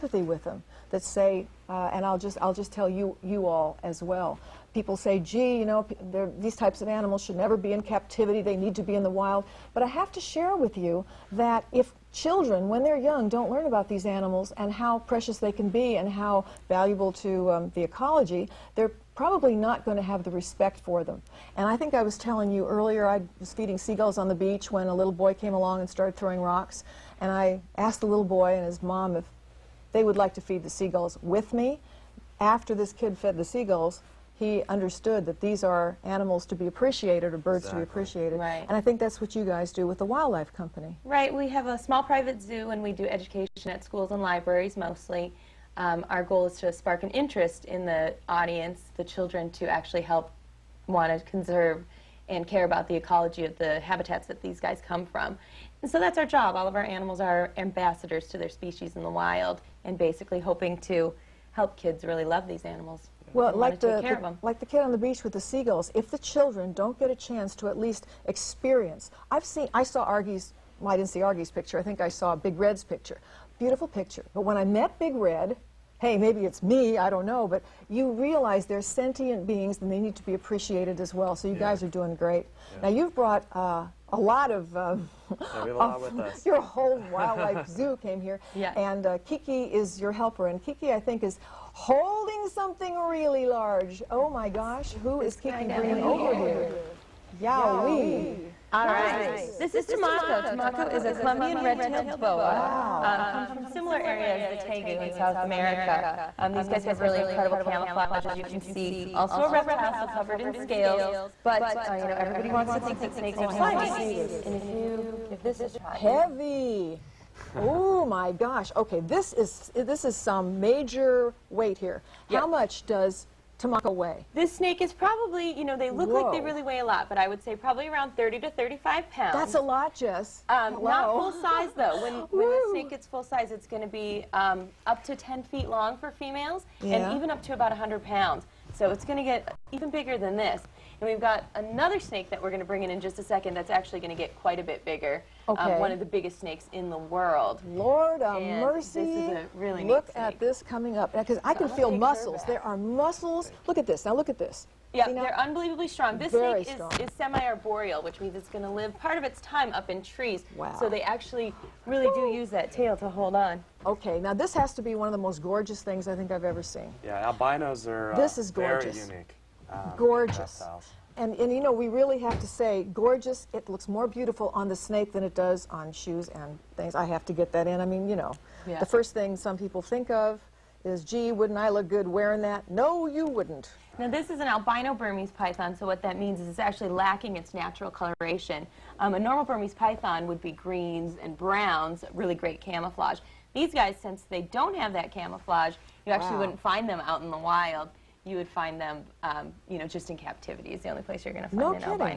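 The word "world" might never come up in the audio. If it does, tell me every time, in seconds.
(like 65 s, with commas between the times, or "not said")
146 s.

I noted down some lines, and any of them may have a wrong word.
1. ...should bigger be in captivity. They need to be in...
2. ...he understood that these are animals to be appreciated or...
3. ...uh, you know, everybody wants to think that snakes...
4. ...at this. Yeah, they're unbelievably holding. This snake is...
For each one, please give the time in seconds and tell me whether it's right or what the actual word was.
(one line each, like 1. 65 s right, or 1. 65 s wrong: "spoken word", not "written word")
1. 7 s wrong: "never", not "bigger"
2. 34 s right
3. 111 s right
4. 154 s wrong: "strong", not "holding".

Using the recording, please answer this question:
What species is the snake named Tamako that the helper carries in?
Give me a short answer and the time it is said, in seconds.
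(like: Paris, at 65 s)
Colombian red-tailed boa, at 101 s.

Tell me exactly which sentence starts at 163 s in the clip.
Okay, now this has to be one of the most gorgeous things I think I've ever seen.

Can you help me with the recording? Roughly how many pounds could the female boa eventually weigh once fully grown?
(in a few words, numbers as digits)
100 pounds.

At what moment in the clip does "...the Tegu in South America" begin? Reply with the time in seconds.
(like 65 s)
104 s.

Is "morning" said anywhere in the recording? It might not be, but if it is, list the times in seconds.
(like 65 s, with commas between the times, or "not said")
not said.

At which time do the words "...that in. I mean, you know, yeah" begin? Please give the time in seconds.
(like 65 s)
177 s.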